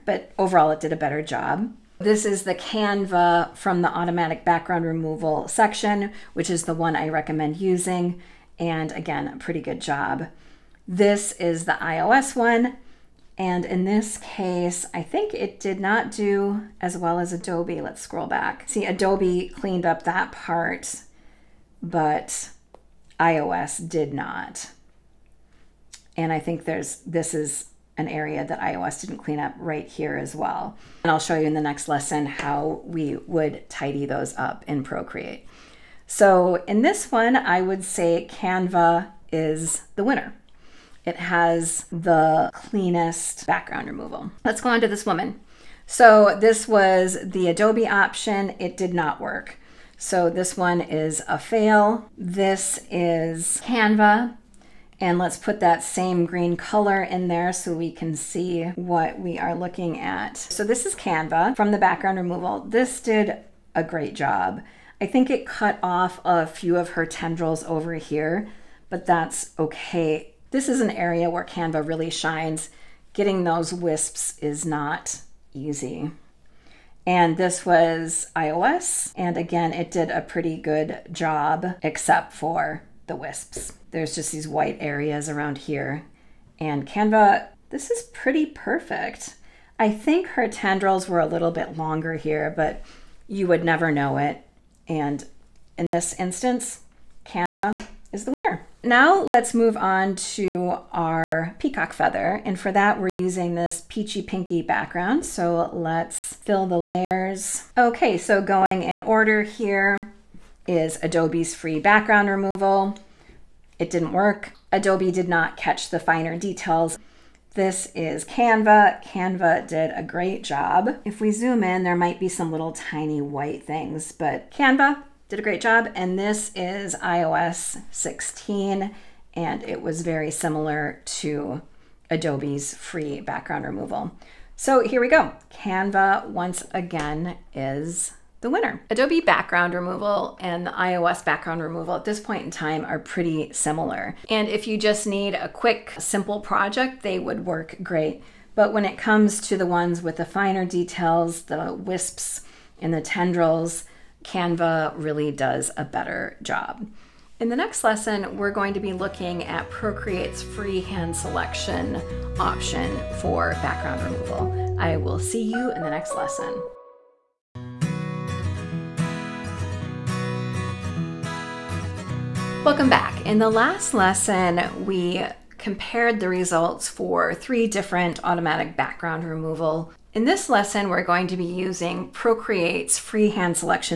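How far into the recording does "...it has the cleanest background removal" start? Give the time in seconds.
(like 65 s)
41 s.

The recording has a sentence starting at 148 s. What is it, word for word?
But when it comes to the ones with the finer details, the wisps and the tendrils, Canva really does a better job.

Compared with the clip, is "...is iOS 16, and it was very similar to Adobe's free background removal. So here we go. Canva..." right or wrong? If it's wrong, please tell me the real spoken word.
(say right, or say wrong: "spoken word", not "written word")
right.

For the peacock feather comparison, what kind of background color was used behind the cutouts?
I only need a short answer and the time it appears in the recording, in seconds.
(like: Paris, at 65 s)
peachy pinky, at 103 s.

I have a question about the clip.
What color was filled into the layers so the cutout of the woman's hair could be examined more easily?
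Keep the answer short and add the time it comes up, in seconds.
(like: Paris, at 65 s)
green, at 56 s.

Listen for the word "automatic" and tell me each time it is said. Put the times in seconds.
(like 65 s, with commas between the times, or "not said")
3 s, 178 s.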